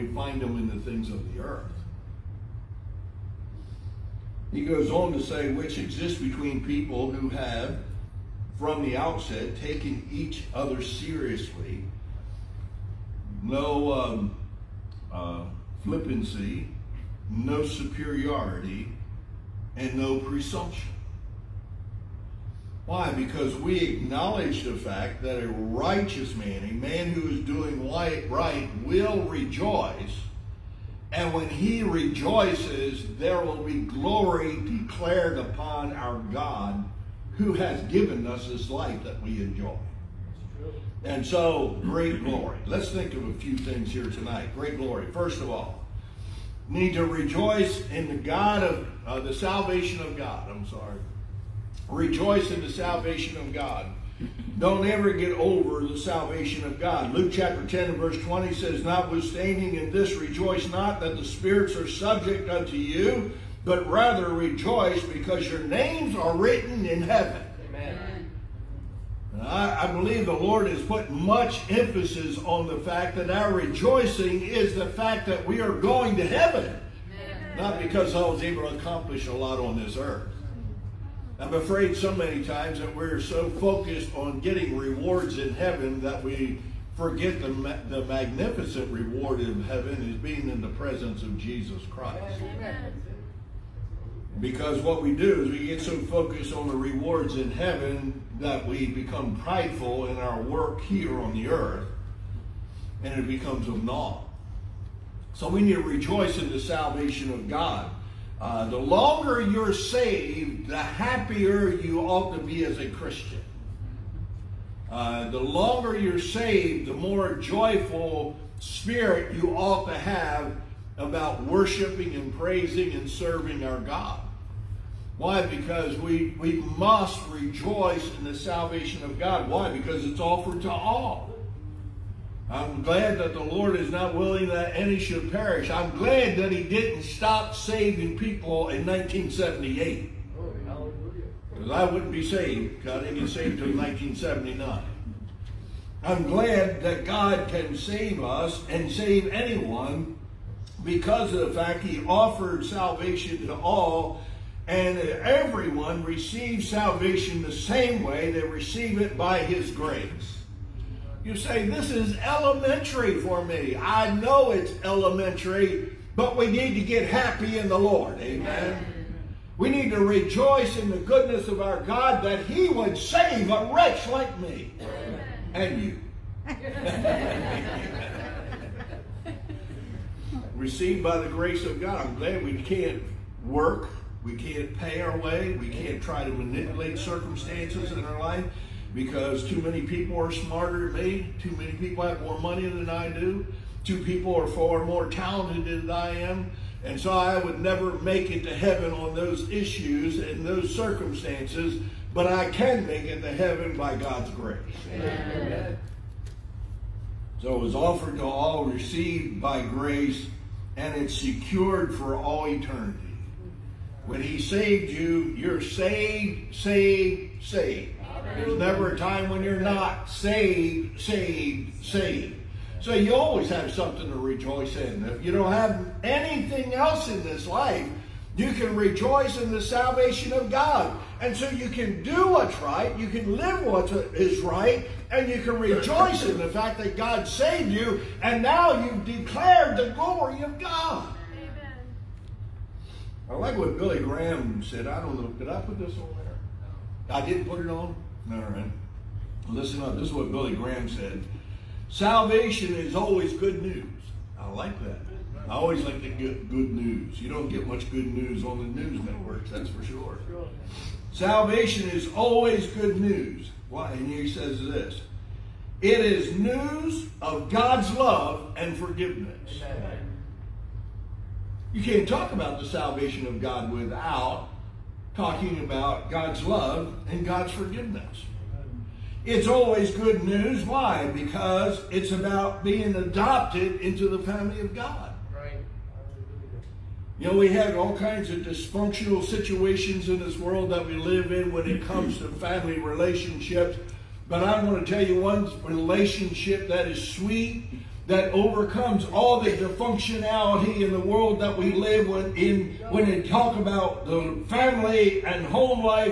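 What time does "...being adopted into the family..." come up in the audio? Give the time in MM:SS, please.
04:42.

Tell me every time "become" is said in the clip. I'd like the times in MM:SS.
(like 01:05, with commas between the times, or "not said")
01:38, 01:43.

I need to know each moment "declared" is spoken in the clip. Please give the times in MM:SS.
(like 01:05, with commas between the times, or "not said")
00:34, 03:59.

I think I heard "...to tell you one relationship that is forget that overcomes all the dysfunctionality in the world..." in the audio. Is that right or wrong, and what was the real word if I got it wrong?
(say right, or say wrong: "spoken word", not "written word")
wrong: "sweet", not "forget".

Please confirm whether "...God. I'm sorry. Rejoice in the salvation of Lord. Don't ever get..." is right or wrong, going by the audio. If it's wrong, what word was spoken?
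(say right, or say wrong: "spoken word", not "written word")
wrong: "God", not "Lord".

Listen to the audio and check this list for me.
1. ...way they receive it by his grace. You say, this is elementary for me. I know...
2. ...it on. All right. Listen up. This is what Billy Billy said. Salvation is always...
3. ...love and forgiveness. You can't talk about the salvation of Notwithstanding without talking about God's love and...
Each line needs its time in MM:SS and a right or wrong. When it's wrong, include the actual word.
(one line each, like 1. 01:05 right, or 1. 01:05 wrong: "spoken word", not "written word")
1. 02:38 right
2. 04:07 wrong: "Graham", not "Billy"
3. 04:27 wrong: "God", not "Notwithstanding".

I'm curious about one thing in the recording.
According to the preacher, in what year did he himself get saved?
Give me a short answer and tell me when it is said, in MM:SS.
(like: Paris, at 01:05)
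1979, at 02:23.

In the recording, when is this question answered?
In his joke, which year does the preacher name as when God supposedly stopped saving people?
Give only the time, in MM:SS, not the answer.
02:18.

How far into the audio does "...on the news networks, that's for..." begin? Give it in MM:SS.
04:18.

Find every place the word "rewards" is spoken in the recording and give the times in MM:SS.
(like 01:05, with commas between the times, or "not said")
01:24, 01:28, 01:36.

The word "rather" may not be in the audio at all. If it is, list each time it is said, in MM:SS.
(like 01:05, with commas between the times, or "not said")
01:03.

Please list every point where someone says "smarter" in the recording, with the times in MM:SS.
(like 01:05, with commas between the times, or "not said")
03:10.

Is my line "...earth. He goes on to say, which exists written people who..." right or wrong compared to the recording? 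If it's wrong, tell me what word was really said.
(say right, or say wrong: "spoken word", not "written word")
wrong: "between", not "written".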